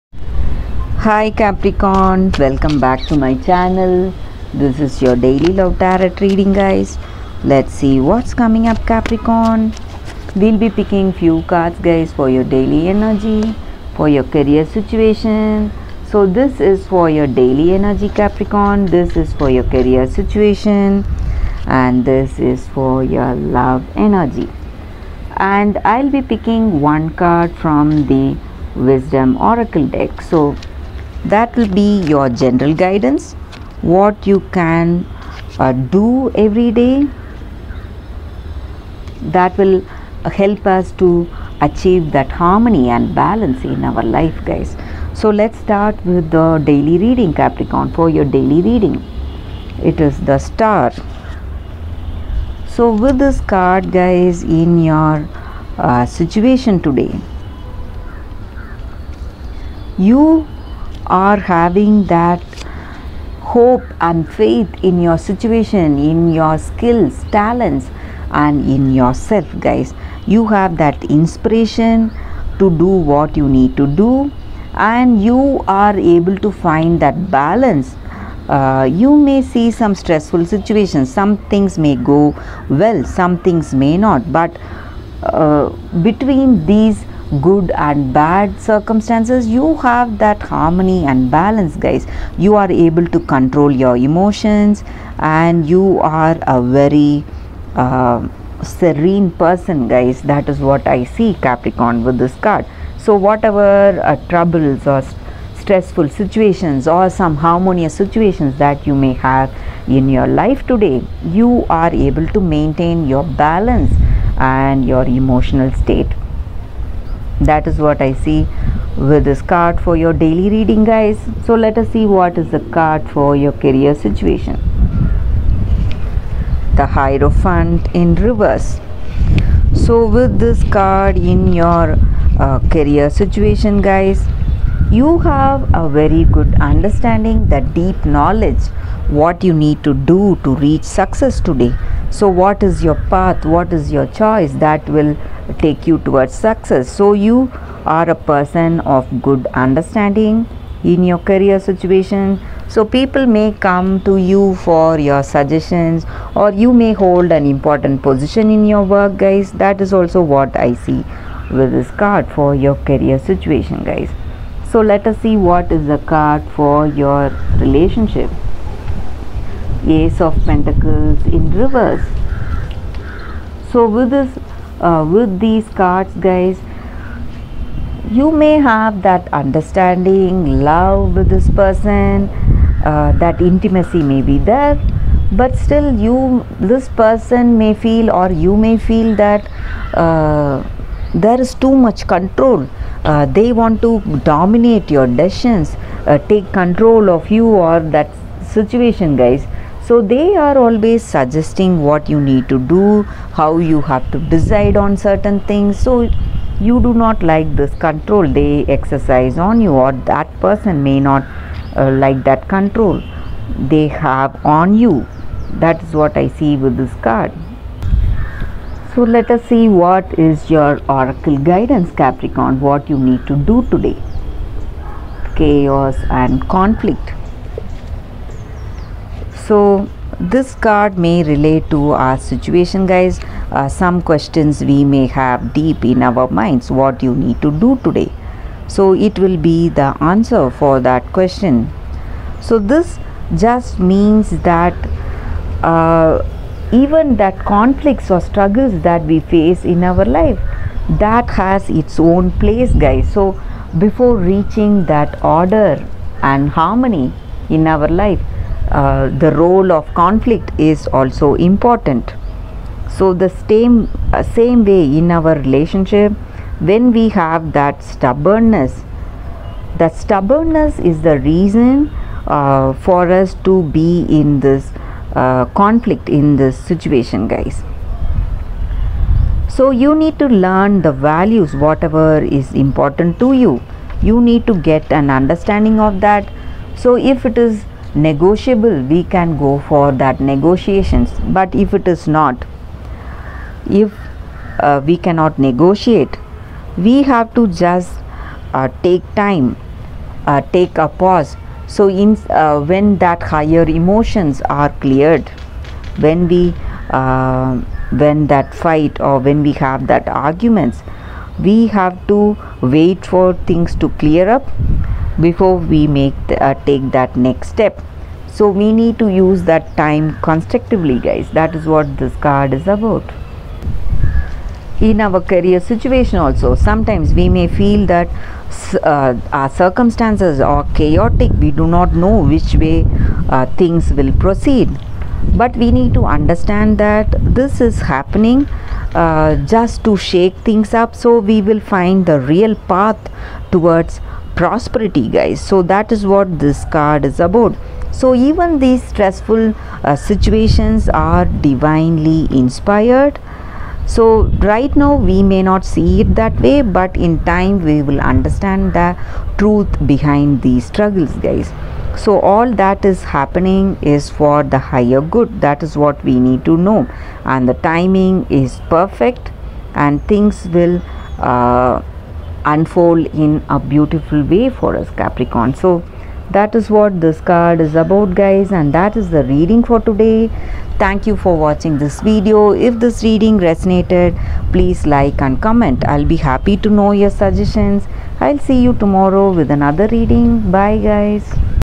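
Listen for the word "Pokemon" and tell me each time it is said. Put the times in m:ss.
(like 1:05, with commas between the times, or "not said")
not said.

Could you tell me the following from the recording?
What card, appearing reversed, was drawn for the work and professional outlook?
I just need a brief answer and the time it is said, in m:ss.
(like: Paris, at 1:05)
The Hierophant, at 2:06.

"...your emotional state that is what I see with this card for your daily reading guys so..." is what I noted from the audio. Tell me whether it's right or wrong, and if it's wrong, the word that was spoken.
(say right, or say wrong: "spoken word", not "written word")
right.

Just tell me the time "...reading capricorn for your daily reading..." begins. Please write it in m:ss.
0:46.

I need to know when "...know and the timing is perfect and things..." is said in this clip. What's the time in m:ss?
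6:06.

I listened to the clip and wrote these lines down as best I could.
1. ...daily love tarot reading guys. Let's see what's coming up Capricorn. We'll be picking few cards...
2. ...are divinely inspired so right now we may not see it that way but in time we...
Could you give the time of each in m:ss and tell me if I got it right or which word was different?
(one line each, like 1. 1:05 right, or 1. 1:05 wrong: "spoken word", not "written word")
1. 0:05 right
2. 5:50 right.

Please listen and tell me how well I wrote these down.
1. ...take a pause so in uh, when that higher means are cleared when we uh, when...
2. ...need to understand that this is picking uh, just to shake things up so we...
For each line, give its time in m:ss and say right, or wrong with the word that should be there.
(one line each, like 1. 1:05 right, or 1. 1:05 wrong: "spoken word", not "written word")
1. 5:00 wrong: "emotions", not "means"
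2. 5:35 wrong: "happening", not "picking".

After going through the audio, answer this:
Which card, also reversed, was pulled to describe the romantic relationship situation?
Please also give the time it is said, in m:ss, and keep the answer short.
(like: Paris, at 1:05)
Ace of Pentacles, at 2:49.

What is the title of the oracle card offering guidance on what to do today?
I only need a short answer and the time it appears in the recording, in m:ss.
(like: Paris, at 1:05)
Chaos and Conflict, at 3:45.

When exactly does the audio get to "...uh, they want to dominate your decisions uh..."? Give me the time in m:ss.
3:13.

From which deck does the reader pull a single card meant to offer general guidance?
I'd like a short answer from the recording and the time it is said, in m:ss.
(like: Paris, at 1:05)
Wisdom Oracle, at 0:28.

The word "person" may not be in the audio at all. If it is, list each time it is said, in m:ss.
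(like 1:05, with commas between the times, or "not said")
1:39, 2:28, 3:01, 3:06, 3:30.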